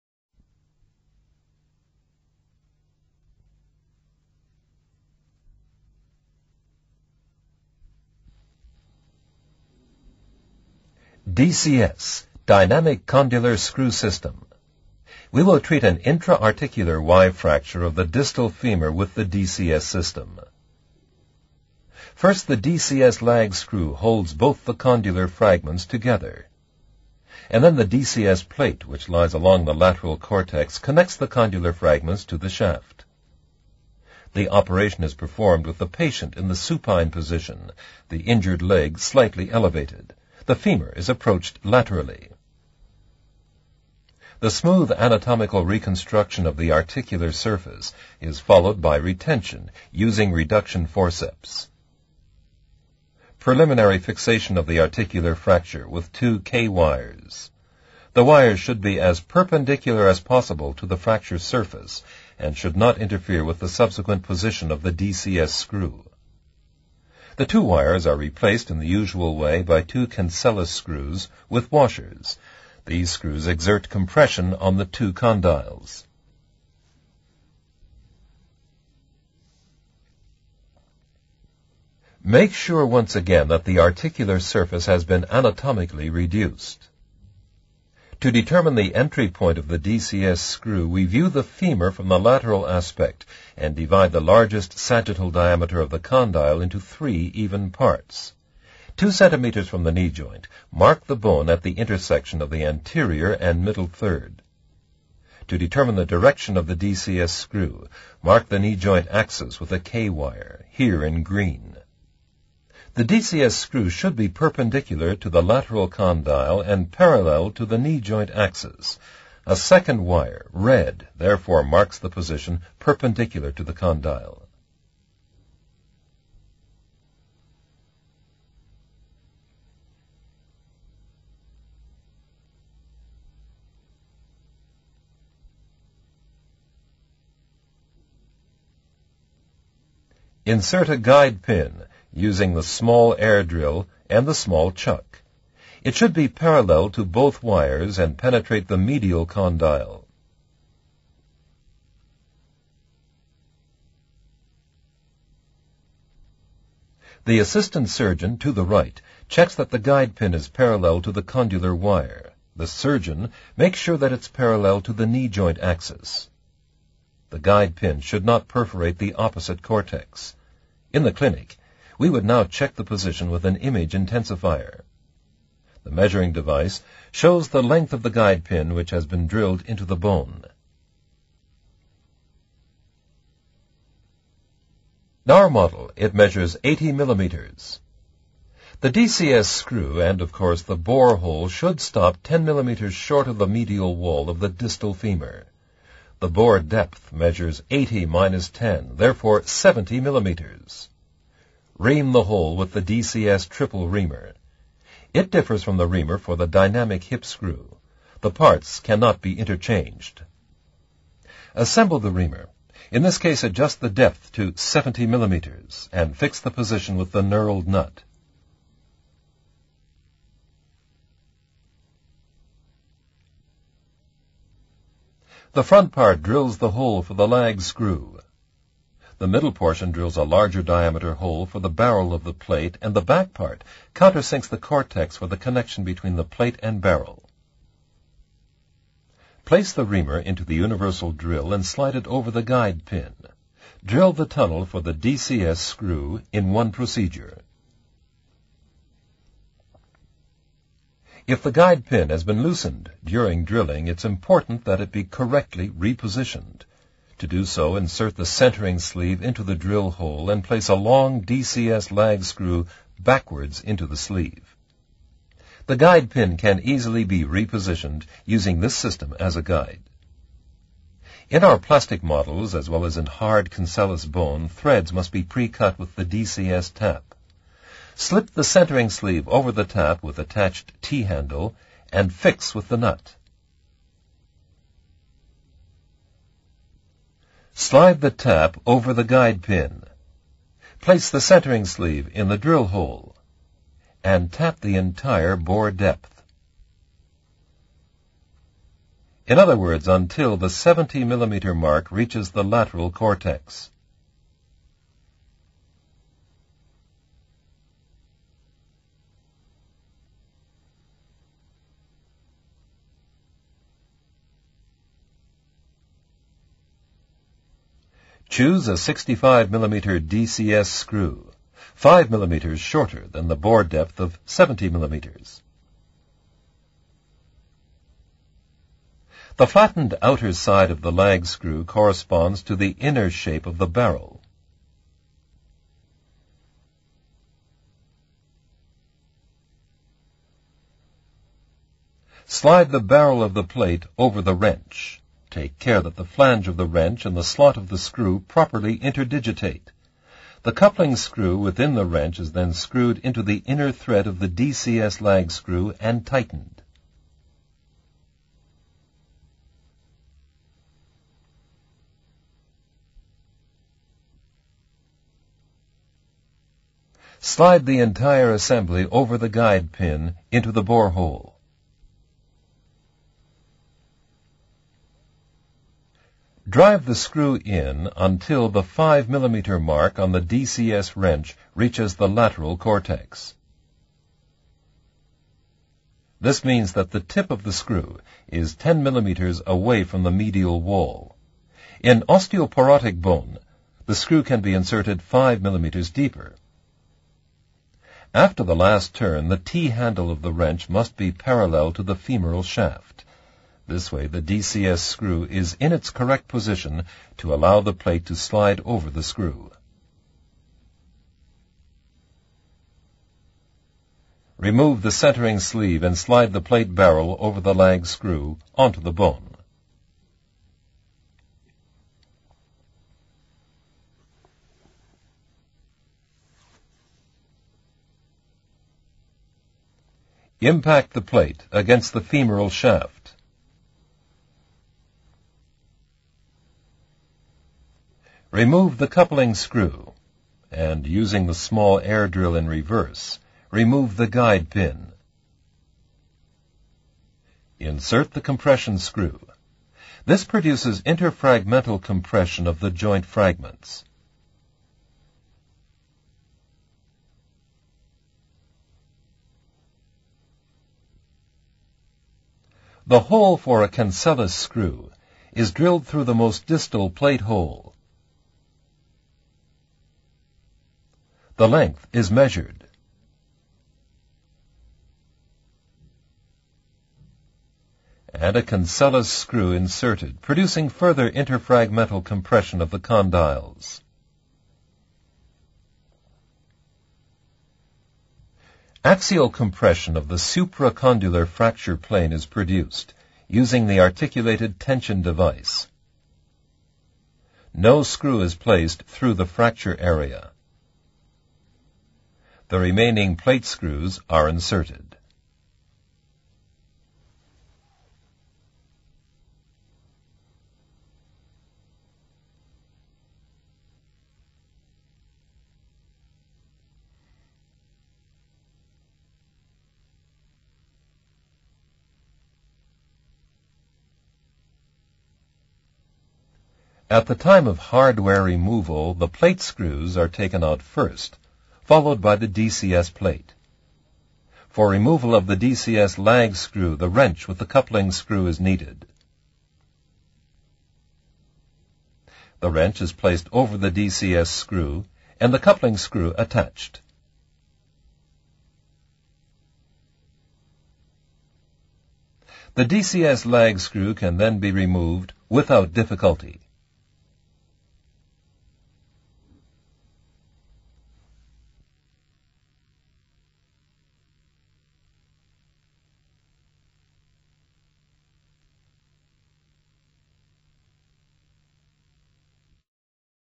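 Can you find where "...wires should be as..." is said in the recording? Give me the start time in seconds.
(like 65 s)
58 s.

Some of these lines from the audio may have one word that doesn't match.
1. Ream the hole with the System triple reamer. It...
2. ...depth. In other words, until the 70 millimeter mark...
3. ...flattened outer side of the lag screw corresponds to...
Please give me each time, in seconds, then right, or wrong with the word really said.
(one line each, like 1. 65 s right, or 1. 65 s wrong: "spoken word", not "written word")
1. 201 s wrong: "DCS", not "System"
2. 295 s right
3. 329 s right.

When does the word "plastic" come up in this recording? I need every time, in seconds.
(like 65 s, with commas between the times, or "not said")
271 s.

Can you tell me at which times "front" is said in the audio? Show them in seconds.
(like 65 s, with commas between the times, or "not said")
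225 s.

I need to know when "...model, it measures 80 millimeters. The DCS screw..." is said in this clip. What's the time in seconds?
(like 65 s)
185 s.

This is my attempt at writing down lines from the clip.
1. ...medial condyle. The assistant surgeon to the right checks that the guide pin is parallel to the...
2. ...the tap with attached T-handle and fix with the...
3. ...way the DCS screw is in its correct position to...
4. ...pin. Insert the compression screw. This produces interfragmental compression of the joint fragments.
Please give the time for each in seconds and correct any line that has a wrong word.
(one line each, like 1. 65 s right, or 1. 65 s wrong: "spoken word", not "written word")
1. 148 s right
2. 279 s right
3. 403 s right
4. 444 s right.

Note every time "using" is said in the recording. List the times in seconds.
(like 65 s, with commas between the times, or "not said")
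49 s, 142 s, 268 s, 440 s, 493 s.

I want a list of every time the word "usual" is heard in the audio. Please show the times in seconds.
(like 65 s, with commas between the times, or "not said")
68 s.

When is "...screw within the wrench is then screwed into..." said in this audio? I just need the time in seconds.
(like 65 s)
350 s.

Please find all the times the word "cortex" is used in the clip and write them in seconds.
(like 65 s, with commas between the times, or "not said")
30 s, 169 s, 234 s, 302 s, 382 s.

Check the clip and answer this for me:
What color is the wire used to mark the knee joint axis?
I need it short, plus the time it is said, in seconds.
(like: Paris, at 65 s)
Green, at 111 s.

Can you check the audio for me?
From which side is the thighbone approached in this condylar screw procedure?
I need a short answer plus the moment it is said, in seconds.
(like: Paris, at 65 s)
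Laterally, at 41 s.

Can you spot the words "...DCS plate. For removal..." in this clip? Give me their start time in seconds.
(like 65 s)
532 s.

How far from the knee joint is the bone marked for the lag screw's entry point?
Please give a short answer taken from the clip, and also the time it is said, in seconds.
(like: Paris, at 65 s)
Two centimeters, at 98 s.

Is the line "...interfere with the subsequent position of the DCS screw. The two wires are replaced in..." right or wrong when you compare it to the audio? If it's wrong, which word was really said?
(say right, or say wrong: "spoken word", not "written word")
right.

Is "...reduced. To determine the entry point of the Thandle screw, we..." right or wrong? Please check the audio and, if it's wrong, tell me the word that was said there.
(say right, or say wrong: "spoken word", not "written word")
wrong: "DCS", not "Thandle".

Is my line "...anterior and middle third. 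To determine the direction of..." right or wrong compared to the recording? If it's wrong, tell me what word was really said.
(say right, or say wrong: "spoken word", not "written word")
right.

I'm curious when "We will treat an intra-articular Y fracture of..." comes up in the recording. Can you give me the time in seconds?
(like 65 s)
15 s.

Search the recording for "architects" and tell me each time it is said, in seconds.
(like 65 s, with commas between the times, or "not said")
not said.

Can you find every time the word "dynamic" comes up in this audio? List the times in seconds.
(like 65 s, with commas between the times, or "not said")
12 s, 206 s.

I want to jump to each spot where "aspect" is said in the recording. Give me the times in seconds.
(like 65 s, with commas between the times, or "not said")
92 s.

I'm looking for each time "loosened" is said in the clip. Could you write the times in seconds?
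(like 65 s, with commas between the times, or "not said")
252 s.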